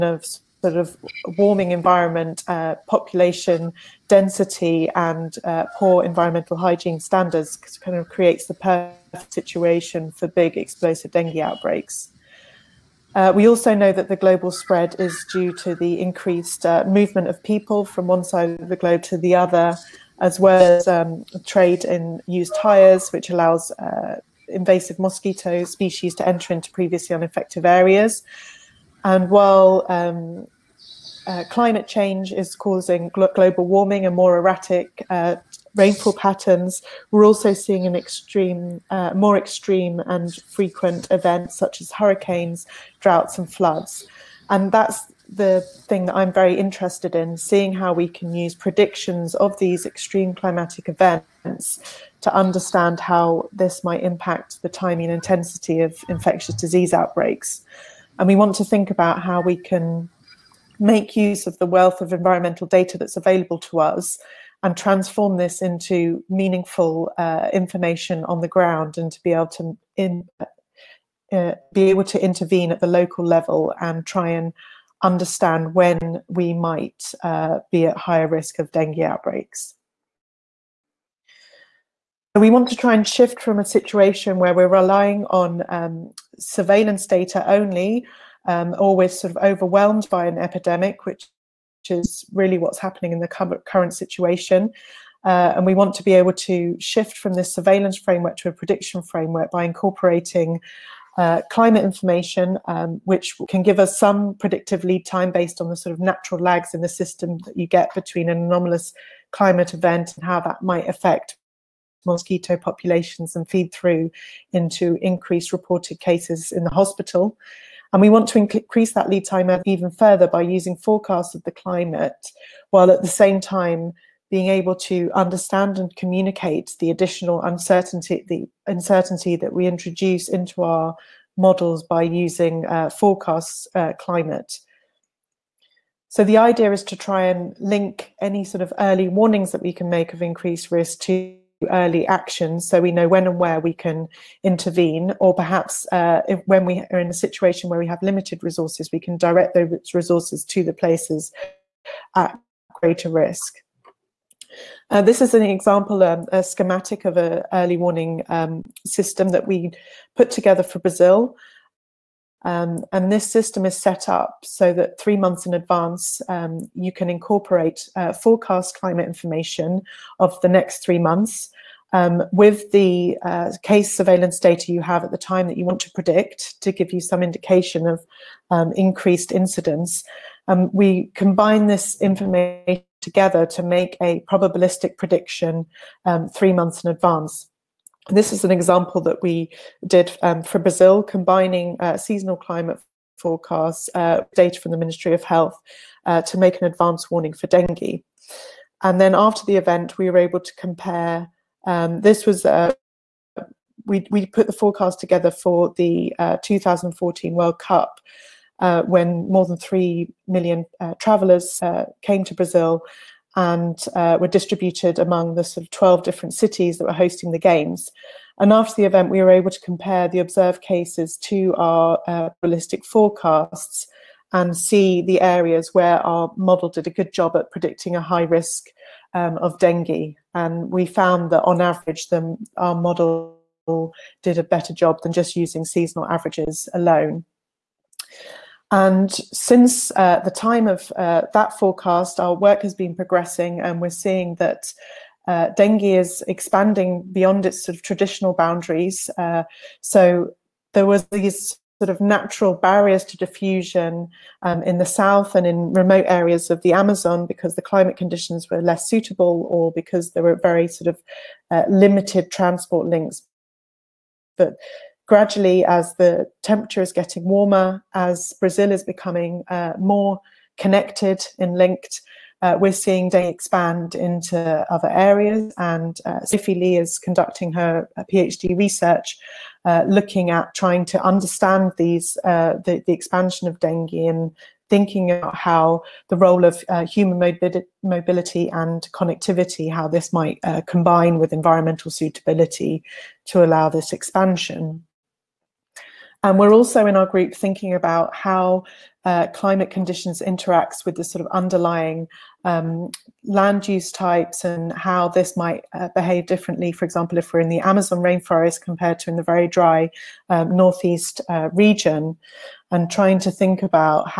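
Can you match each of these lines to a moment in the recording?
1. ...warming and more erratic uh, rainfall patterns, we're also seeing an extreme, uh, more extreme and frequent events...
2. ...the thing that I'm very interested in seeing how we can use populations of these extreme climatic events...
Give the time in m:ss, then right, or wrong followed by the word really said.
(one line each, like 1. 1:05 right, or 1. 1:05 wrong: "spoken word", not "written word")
1. 0:33 right
2. 0:45 wrong: "predictions", not "populations".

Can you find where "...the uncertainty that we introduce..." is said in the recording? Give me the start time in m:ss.
2:08.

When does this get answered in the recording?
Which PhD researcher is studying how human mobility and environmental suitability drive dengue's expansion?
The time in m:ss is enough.
4:36.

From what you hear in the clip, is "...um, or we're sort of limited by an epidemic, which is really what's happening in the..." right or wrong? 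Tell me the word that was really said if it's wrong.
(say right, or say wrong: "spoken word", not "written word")
wrong: "overwhelmed", not "limited".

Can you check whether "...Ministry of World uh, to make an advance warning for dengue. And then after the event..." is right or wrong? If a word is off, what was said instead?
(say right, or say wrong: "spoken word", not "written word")
wrong: "Health", not "World".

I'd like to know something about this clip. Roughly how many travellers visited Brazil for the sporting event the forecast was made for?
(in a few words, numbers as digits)
More than 3 million.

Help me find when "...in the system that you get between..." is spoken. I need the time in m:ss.
1:46.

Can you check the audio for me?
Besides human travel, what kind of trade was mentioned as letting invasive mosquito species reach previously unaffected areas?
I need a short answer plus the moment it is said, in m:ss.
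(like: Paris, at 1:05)
Used tyres, at 0:21.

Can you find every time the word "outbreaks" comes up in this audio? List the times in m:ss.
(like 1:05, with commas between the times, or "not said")
0:11, 0:56, 1:19.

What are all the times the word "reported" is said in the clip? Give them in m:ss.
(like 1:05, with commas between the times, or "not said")
1:55.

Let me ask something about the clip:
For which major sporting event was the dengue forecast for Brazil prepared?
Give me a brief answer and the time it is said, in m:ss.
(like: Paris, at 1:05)
2014 World Cup, at 3:26.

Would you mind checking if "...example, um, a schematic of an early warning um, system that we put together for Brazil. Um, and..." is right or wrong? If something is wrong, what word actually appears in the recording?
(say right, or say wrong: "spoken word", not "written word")
right.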